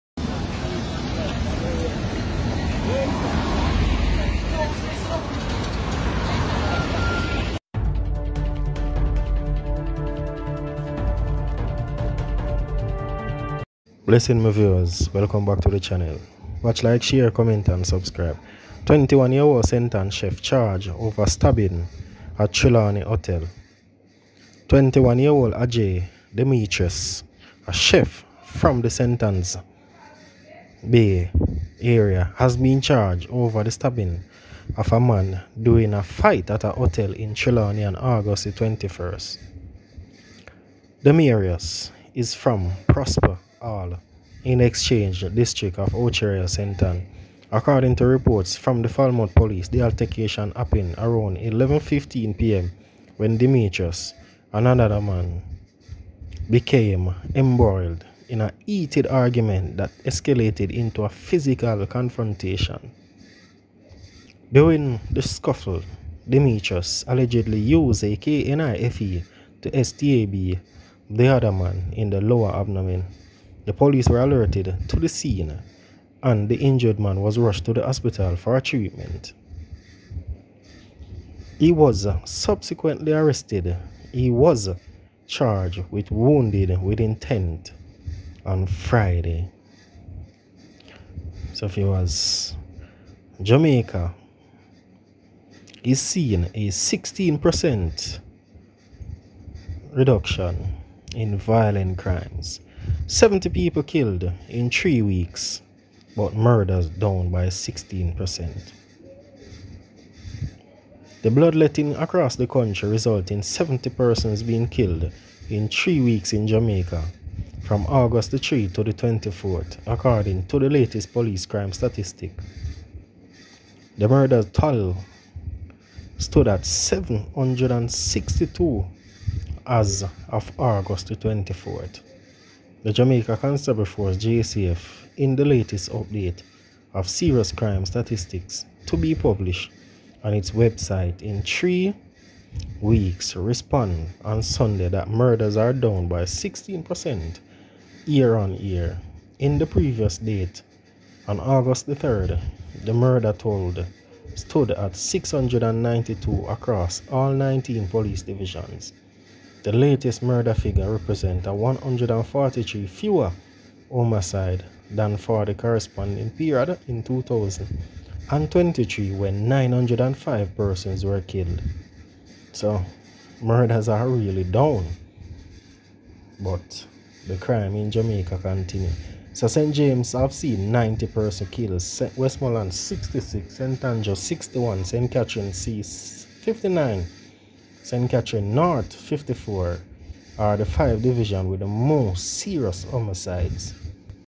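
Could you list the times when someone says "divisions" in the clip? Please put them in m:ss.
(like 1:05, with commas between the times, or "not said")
2:38, 3:11.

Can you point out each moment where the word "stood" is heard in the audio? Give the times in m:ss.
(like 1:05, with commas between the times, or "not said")
2:06, 2:34.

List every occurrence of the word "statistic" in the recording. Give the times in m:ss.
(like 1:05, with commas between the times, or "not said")
2:01, 2:17.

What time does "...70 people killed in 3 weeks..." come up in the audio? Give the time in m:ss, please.
1:43.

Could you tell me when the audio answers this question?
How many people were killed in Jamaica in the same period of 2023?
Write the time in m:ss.
2:49.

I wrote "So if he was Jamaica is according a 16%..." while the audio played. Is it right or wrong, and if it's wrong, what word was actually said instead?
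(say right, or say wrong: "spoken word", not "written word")
wrong: "seeing", not "according".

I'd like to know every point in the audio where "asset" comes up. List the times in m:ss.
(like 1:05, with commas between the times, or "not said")
not said.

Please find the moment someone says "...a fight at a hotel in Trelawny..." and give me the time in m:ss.
0:35.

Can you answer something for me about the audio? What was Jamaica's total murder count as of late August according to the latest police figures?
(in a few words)
762.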